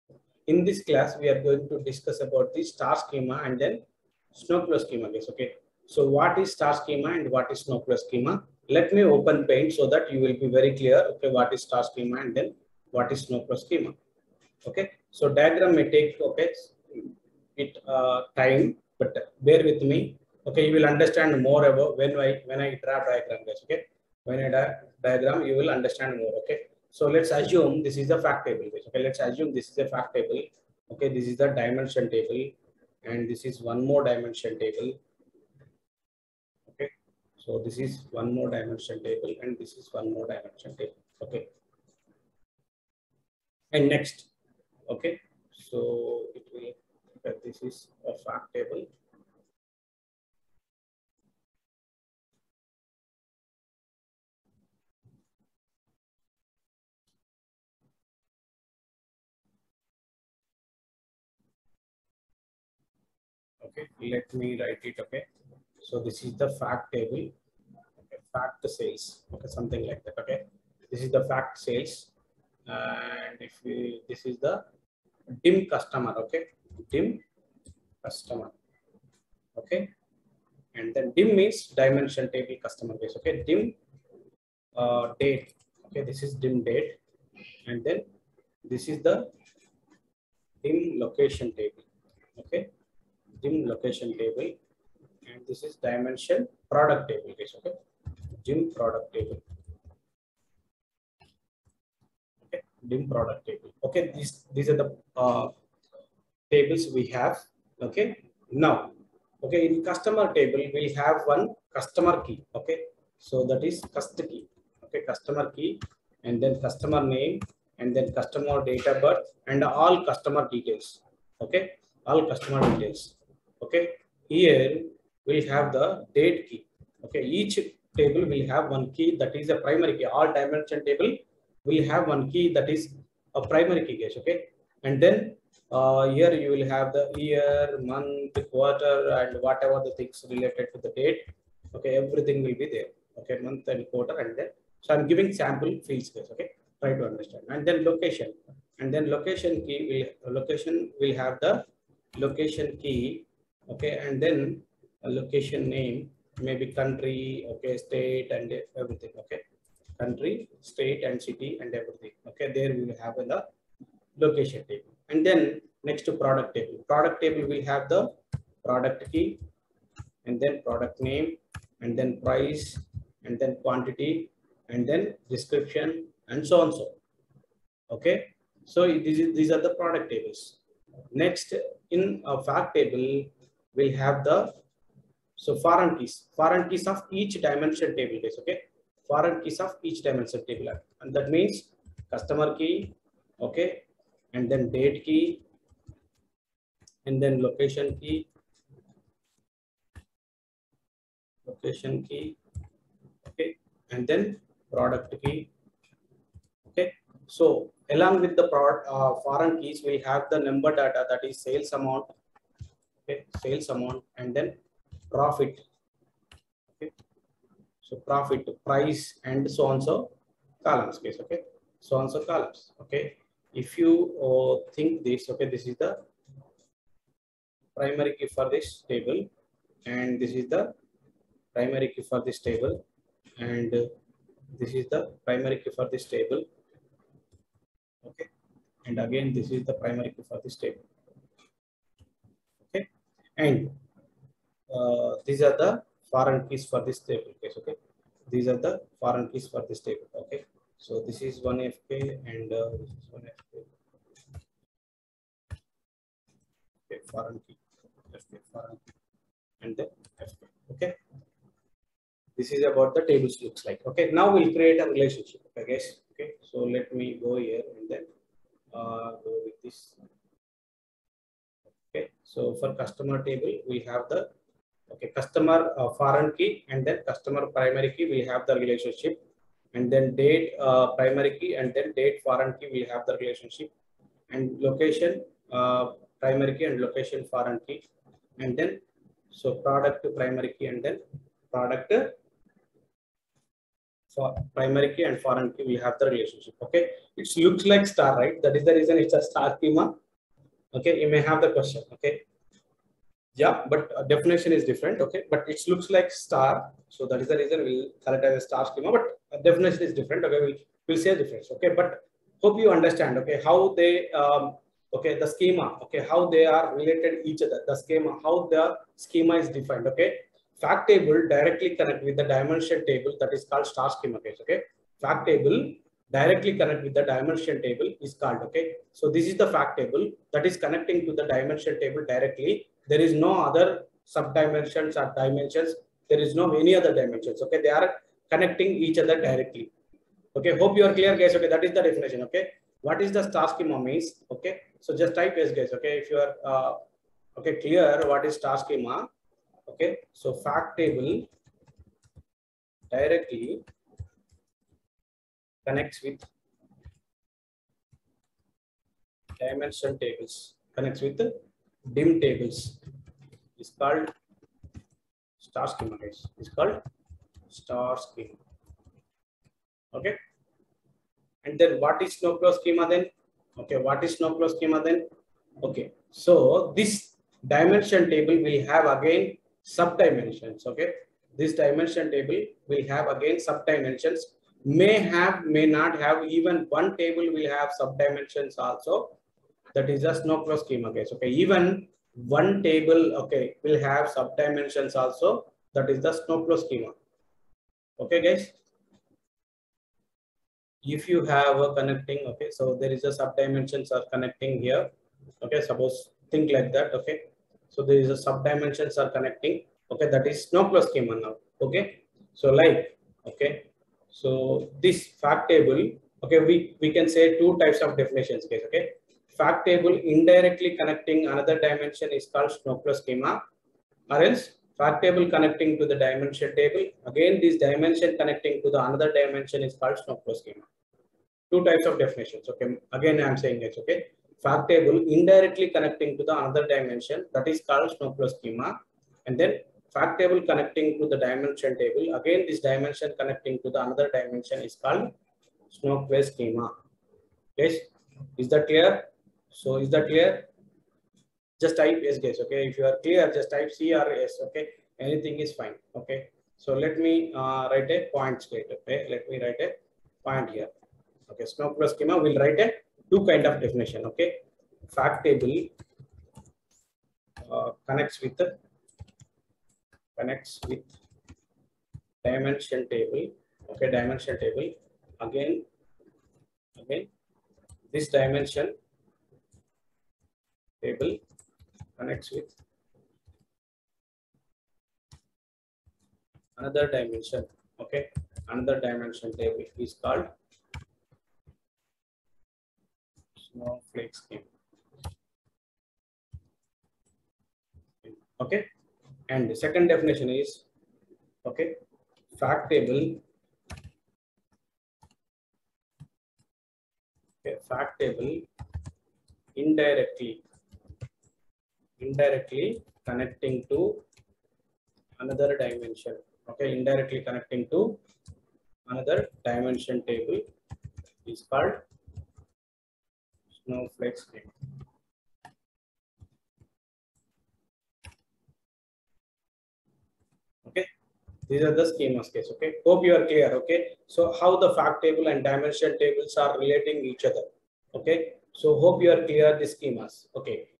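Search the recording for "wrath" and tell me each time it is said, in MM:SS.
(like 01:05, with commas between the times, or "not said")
not said.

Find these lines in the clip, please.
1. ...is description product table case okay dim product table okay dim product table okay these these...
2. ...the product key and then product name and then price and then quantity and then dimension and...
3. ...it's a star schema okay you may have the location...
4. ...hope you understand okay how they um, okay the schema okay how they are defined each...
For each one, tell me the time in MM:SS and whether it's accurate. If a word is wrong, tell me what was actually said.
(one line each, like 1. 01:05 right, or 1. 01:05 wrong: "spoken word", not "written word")
1. 01:35 wrong: "dimension", not "description"
2. 02:47 wrong: "description", not "dimension"
3. 04:58 wrong: "question", not "location"
4. 05:12 wrong: "related", not "defined".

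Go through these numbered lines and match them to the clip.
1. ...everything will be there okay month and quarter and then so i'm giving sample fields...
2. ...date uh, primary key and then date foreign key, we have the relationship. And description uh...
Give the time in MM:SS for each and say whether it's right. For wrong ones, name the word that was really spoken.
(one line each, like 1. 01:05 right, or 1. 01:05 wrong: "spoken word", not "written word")
1. 02:22 right
2. 04:40 wrong: "location", not "description".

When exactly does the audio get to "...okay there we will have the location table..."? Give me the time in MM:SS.
02:42.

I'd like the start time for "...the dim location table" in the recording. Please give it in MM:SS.
01:28.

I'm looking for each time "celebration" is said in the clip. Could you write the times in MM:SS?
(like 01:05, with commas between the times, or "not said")
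not said.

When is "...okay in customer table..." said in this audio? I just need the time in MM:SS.
01:49.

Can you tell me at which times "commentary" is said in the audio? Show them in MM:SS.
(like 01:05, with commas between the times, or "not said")
not said.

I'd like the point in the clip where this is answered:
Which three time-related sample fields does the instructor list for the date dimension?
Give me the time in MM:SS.
02:17.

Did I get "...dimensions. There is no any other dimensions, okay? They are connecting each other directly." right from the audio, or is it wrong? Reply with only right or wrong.
right.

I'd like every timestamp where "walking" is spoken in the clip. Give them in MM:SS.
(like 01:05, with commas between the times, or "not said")
not said.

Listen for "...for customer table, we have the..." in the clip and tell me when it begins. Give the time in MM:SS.
04:32.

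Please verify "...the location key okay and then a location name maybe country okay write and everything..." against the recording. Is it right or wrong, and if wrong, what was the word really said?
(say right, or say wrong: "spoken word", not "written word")
wrong: "state", not "write".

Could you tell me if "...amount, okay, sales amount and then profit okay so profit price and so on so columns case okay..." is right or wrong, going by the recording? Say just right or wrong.
right.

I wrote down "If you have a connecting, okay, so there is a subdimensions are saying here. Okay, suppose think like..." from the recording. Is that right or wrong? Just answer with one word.
wrong.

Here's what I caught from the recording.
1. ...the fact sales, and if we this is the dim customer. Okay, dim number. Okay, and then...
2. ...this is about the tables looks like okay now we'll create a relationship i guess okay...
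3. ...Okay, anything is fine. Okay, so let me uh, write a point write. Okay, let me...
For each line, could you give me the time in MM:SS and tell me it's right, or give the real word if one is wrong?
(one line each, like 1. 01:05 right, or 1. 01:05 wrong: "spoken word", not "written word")
1. 01:11 wrong: "customer", not "number"
2. 04:22 right
3. 07:34 wrong: "state", not "write".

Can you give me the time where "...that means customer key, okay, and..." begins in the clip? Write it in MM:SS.
03:11.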